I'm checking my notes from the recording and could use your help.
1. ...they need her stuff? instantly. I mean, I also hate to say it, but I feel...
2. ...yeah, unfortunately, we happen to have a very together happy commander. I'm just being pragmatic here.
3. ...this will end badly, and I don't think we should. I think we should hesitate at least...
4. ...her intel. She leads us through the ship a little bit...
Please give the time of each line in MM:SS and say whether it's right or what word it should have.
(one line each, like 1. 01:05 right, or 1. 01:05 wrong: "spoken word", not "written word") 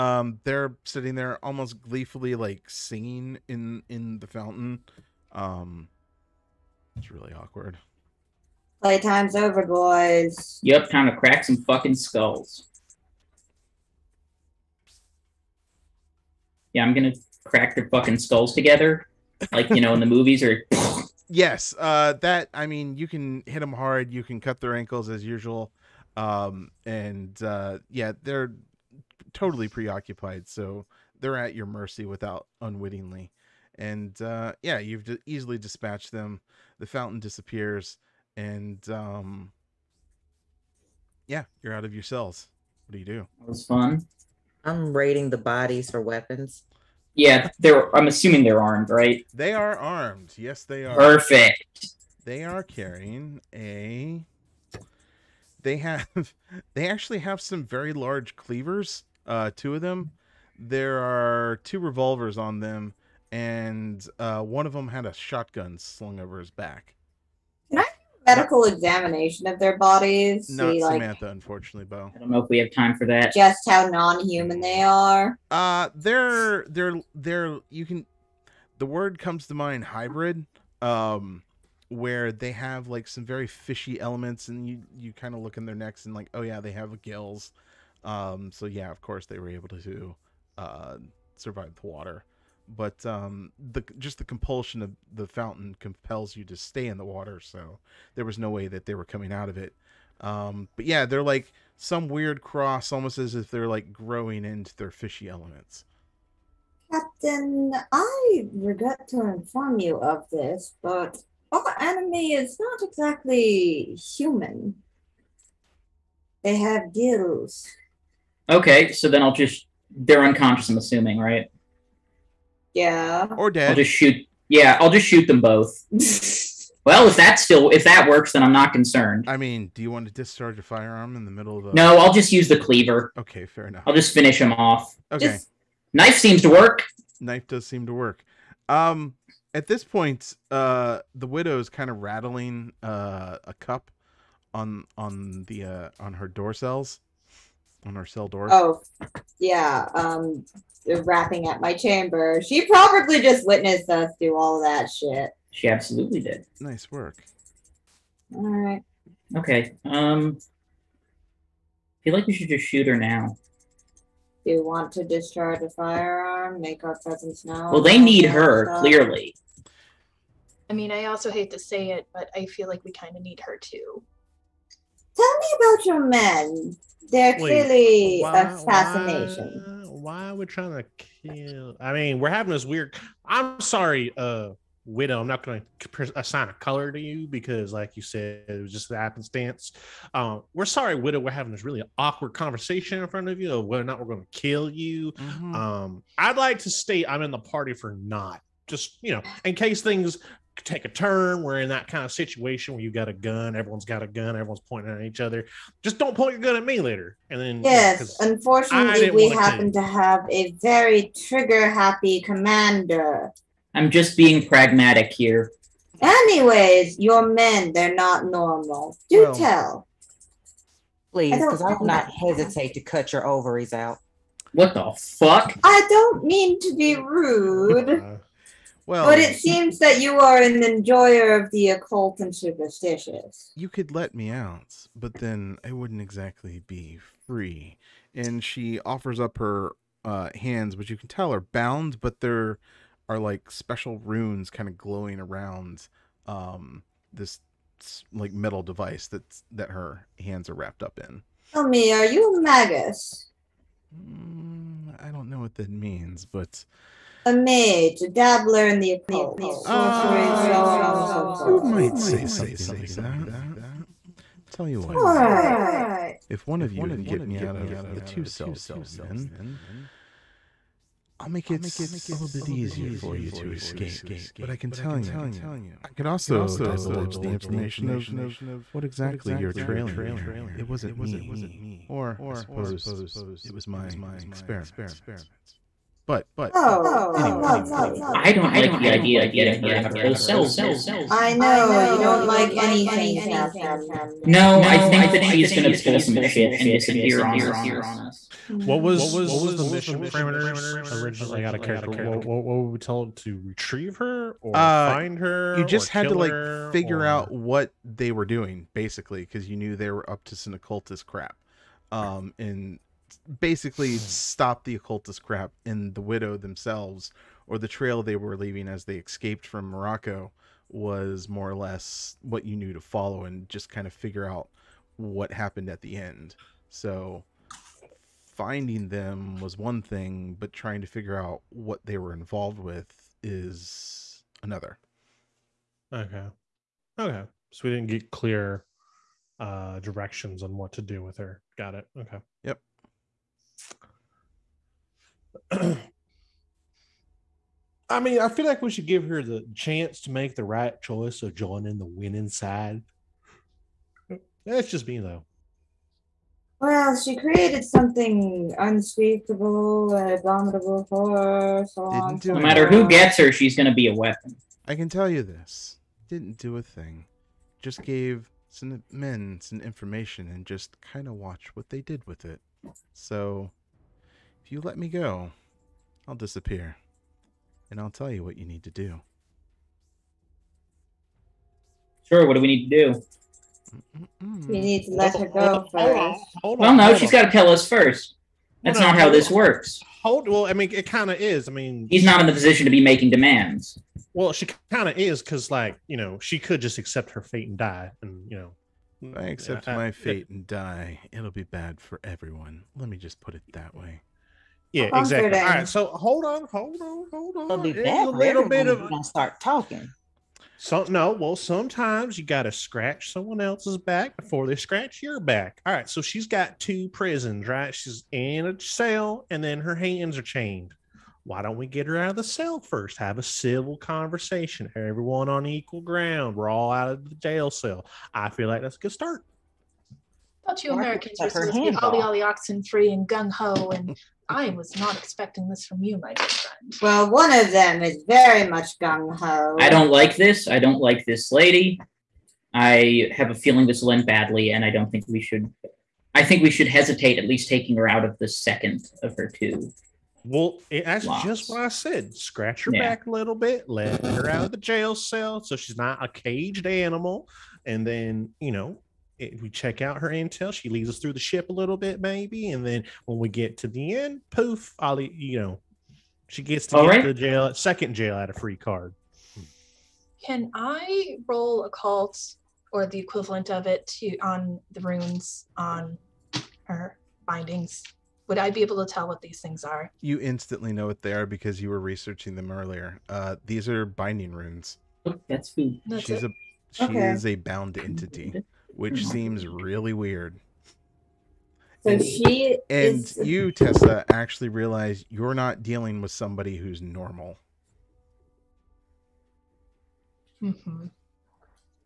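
1. 02:47 wrong: "clearly", not "instantly"
2. 03:28 wrong: "trigger", not "together"
3. 07:23 right
4. 07:39 right.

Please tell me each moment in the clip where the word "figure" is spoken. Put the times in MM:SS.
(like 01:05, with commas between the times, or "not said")
05:06, 05:23, 05:30.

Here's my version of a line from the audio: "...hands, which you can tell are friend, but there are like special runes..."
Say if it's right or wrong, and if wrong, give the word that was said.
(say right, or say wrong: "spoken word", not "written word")
wrong: "bound", not "friend".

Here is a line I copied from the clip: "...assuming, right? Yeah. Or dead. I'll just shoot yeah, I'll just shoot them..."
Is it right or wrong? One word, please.
right.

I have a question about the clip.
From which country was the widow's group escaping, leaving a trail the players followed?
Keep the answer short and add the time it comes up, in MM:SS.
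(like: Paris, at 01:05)
Morocco, at 05:19.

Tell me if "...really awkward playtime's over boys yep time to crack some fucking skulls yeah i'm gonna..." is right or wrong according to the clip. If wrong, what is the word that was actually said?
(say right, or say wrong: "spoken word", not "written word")
right.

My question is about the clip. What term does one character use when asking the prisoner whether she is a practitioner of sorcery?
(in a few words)
Magus.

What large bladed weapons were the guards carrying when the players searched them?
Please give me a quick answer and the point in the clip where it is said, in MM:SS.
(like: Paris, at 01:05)
Cleavers, at 00:58.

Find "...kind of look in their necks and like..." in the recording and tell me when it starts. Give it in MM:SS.
01:25.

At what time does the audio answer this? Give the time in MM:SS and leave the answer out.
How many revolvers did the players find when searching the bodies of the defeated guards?
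01:01.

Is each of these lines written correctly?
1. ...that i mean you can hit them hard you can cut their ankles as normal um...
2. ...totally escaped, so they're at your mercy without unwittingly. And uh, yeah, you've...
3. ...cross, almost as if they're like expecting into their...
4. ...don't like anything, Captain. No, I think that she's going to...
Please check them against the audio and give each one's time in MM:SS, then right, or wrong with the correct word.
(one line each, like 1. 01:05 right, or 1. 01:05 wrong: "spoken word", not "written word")
1. 00:22 wrong: "usual", not "normal"
2. 00:29 wrong: "preoccupied", not "escaped"
3. 01:42 wrong: "growing", not "expecting"
4. 04:51 right.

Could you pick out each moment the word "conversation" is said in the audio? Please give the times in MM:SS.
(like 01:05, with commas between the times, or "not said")
03:12, 07:03.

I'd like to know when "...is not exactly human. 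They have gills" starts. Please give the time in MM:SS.
01:52.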